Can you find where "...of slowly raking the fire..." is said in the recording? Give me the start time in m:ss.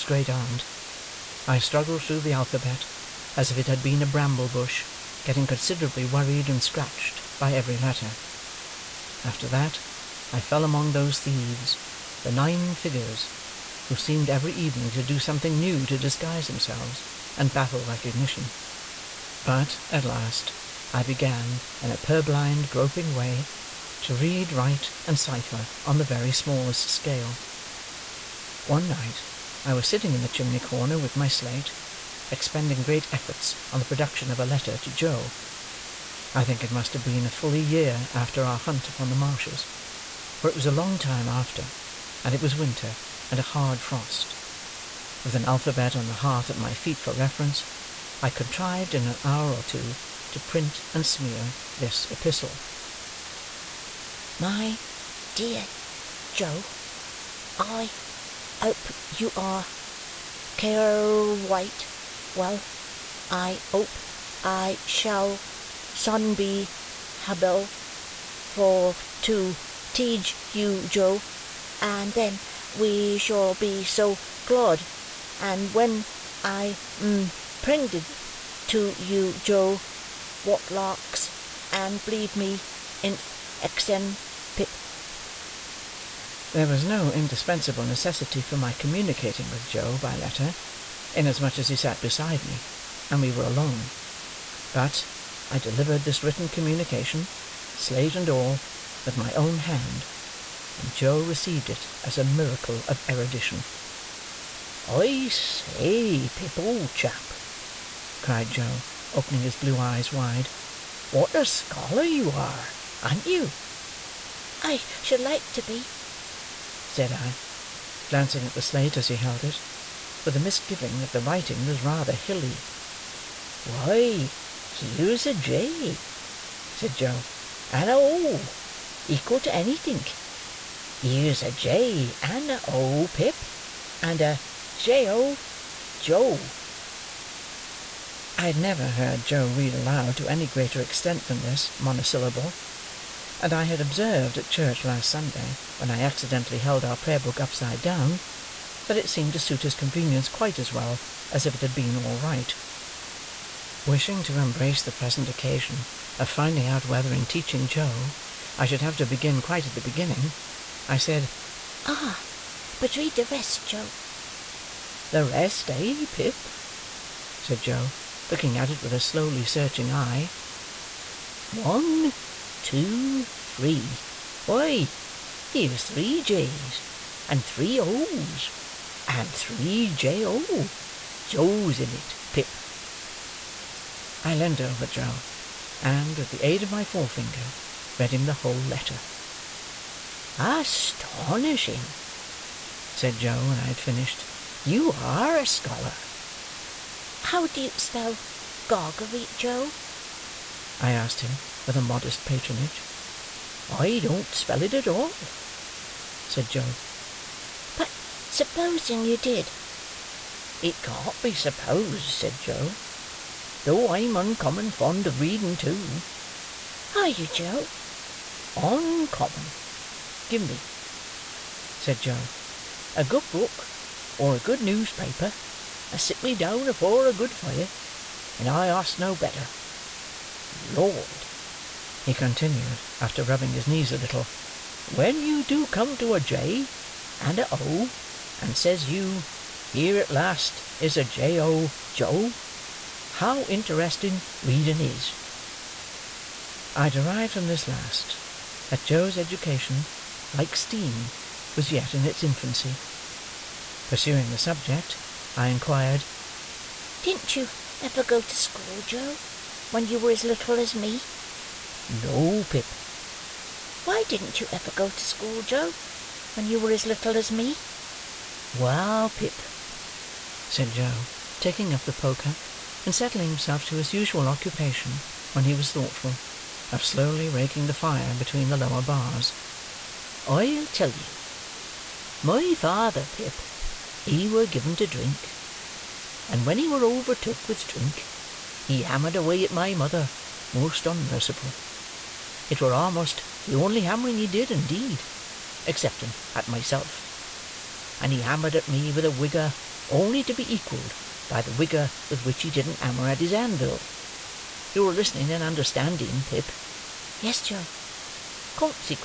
4:36.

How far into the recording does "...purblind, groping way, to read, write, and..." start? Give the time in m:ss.
0:21.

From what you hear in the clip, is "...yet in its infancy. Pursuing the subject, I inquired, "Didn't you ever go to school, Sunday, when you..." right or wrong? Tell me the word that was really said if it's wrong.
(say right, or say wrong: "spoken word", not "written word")
wrong: "Joe", not "Sunday".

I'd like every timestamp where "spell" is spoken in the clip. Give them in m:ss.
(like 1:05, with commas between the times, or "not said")
3:17, 3:24.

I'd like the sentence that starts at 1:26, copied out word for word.
There was no indispensable necessity for my communicating with Joe by letter, inasmuch as he sat beside me, and we were alone.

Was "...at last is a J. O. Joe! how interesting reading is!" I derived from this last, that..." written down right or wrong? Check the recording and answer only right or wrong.
right.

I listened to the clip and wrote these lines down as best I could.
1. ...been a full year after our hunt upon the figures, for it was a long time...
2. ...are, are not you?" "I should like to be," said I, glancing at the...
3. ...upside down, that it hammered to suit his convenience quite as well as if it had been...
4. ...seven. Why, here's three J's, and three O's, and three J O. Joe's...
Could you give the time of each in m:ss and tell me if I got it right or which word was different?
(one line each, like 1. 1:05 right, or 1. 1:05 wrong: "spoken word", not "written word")
1. 0:37 wrong: "marshes", not "figures"
2. 1:52 right
3. 2:27 wrong: "seemed", not "hammered"
4. 2:54 wrong: "three", not "seven".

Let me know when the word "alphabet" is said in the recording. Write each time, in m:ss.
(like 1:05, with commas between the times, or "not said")
0:02, 0:45.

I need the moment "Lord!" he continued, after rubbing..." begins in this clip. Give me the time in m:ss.
3:50.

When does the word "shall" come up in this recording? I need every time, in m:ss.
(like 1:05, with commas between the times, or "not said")
1:04, 1:13.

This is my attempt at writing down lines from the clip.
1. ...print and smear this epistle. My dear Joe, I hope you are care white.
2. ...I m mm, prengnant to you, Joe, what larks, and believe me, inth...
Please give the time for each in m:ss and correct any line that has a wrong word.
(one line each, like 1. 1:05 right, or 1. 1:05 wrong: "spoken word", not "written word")
1. 0:50 right
2. 1:16 right.